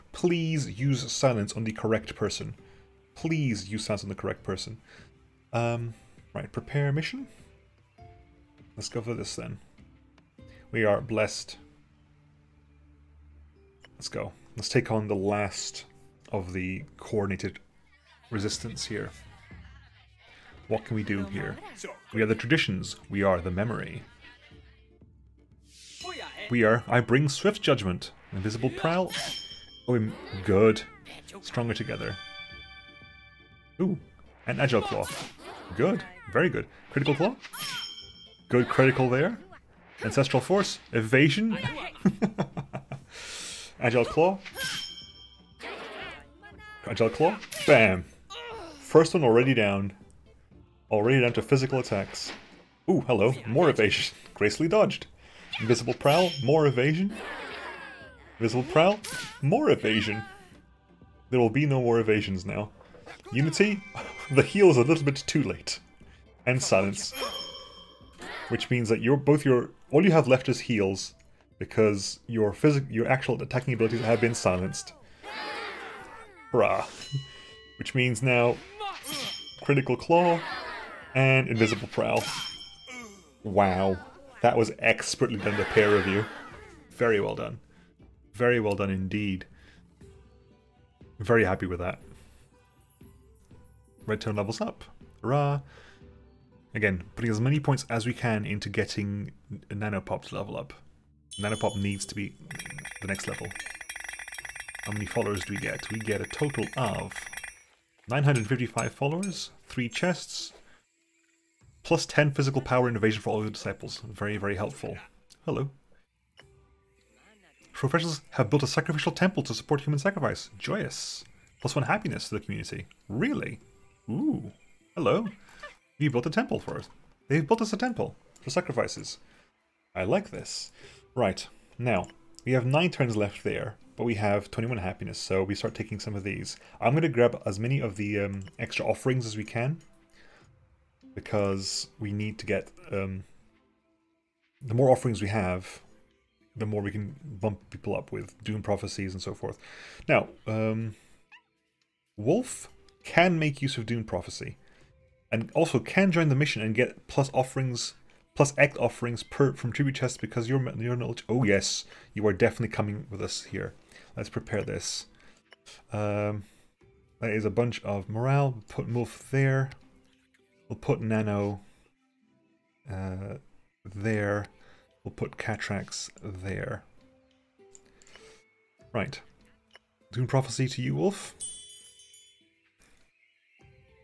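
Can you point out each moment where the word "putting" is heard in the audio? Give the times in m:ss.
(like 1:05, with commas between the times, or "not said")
1:37.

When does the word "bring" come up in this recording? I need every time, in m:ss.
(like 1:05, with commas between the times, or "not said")
0:27.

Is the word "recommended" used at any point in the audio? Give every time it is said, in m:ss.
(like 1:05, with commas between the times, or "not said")
not said.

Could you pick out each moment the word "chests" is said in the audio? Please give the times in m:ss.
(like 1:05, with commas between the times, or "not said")
1:49, 2:39.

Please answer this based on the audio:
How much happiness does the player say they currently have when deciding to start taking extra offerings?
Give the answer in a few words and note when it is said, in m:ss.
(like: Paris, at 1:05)
21, at 2:14.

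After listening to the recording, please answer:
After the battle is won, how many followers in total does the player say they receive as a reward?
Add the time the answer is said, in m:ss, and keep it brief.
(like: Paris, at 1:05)
955, at 1:48.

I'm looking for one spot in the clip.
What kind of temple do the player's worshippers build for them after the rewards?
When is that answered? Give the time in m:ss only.
1:58.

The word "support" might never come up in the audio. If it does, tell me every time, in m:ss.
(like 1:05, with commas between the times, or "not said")
1:59.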